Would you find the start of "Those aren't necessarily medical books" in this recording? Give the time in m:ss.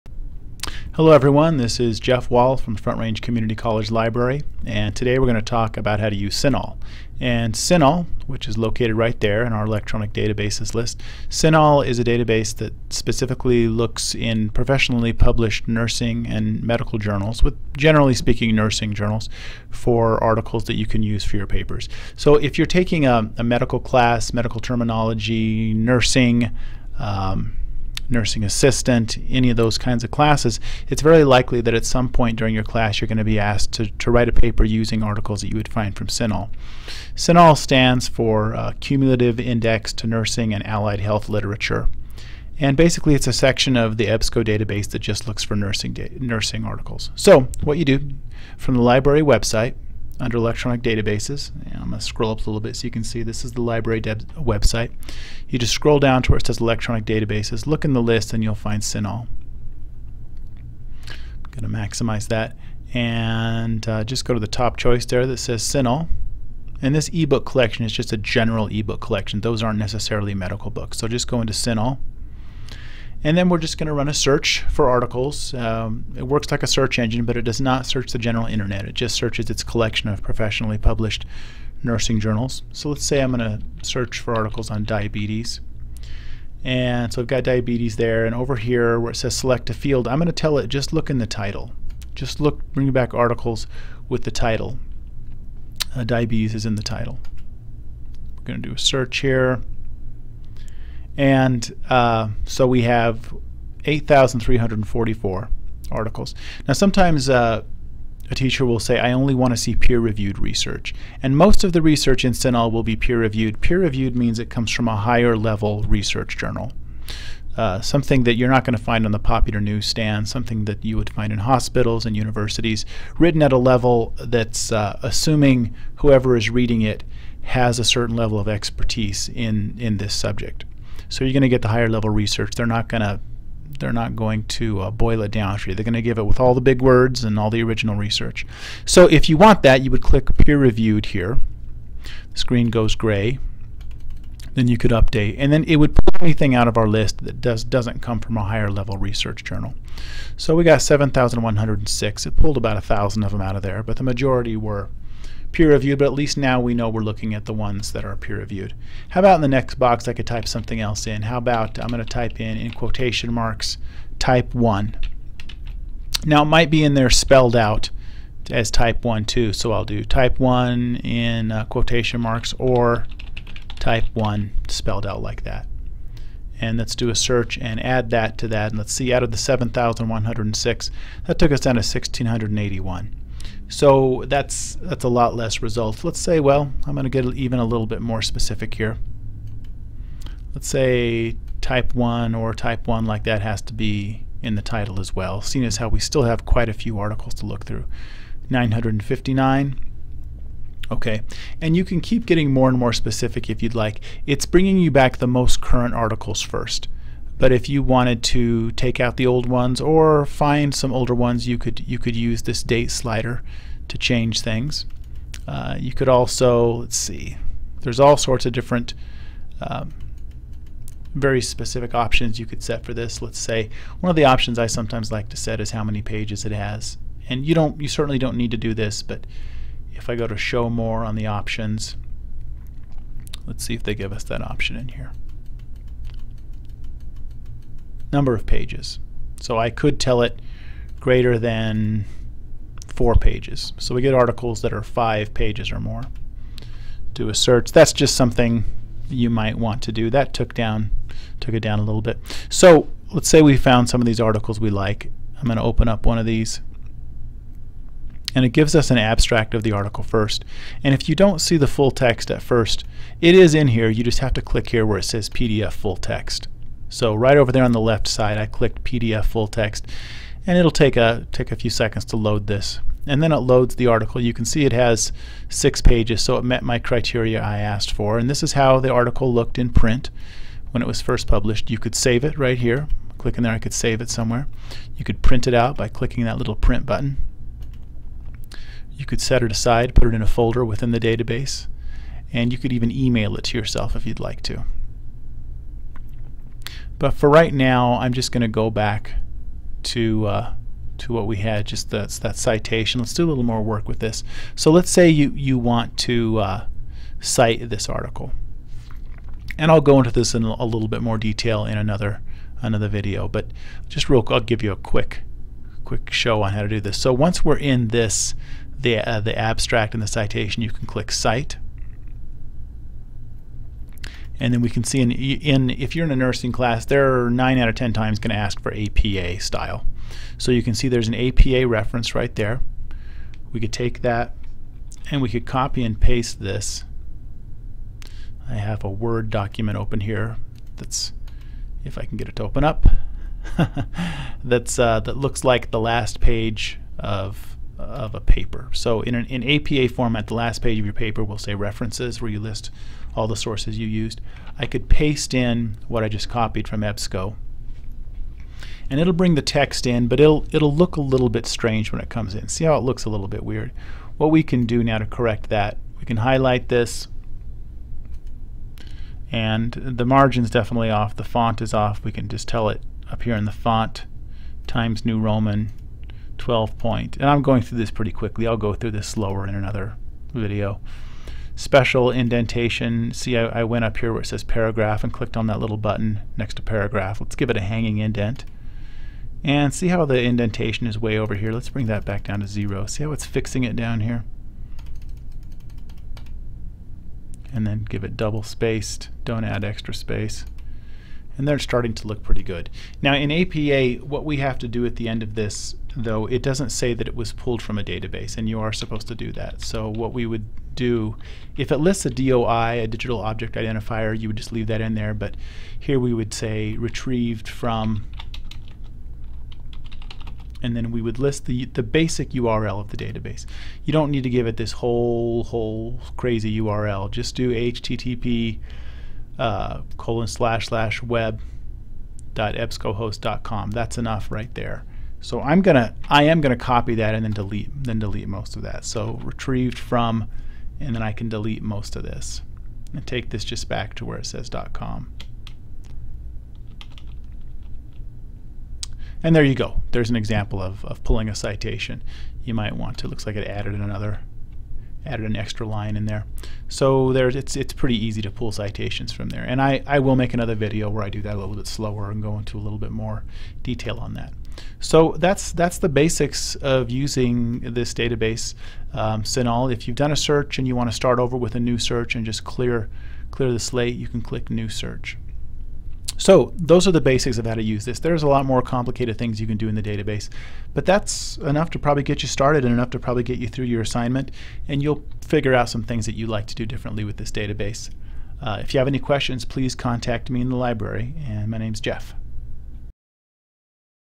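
1:09.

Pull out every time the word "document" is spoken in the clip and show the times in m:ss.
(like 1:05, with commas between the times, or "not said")
5:39.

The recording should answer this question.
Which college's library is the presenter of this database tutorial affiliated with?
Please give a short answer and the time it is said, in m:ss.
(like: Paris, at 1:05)
Front Range Community College, at 0:02.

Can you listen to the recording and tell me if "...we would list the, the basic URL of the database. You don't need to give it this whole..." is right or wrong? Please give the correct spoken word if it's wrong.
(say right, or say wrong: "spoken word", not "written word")
right.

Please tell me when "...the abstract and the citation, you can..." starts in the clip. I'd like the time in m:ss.
5:19.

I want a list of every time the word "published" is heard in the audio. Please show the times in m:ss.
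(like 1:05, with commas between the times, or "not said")
0:15, 1:20, 4:41.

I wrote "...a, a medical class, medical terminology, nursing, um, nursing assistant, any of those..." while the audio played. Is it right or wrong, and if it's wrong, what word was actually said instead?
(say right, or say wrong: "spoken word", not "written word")
right.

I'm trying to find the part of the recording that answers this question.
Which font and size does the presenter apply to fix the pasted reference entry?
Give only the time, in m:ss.
6:14.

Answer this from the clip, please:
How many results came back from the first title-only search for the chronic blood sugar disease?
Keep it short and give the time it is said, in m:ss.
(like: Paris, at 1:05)
8,344, at 1:43.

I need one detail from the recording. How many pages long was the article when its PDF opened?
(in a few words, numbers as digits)
6.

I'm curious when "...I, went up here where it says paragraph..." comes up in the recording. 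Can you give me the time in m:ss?
6:23.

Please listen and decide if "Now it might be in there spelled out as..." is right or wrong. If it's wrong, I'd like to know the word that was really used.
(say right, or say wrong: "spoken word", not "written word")
right.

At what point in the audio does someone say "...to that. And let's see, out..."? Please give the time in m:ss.
2:58.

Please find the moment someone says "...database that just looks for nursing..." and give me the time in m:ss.
0:44.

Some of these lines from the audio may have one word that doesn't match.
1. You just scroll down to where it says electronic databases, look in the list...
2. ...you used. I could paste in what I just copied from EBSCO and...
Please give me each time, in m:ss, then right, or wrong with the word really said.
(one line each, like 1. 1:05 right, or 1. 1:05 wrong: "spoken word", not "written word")
1. 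0:55 right
2. 5:53 right.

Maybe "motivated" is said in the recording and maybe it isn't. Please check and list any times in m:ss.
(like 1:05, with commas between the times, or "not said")
not said.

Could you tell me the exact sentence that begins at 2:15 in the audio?
They're going to give it with all the big words and all the original research.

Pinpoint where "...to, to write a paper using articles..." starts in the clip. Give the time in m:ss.
0:33.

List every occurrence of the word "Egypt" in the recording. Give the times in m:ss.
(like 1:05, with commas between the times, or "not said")
not said.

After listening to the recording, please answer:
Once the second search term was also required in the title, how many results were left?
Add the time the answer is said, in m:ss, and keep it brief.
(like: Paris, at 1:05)
959, at 3:18.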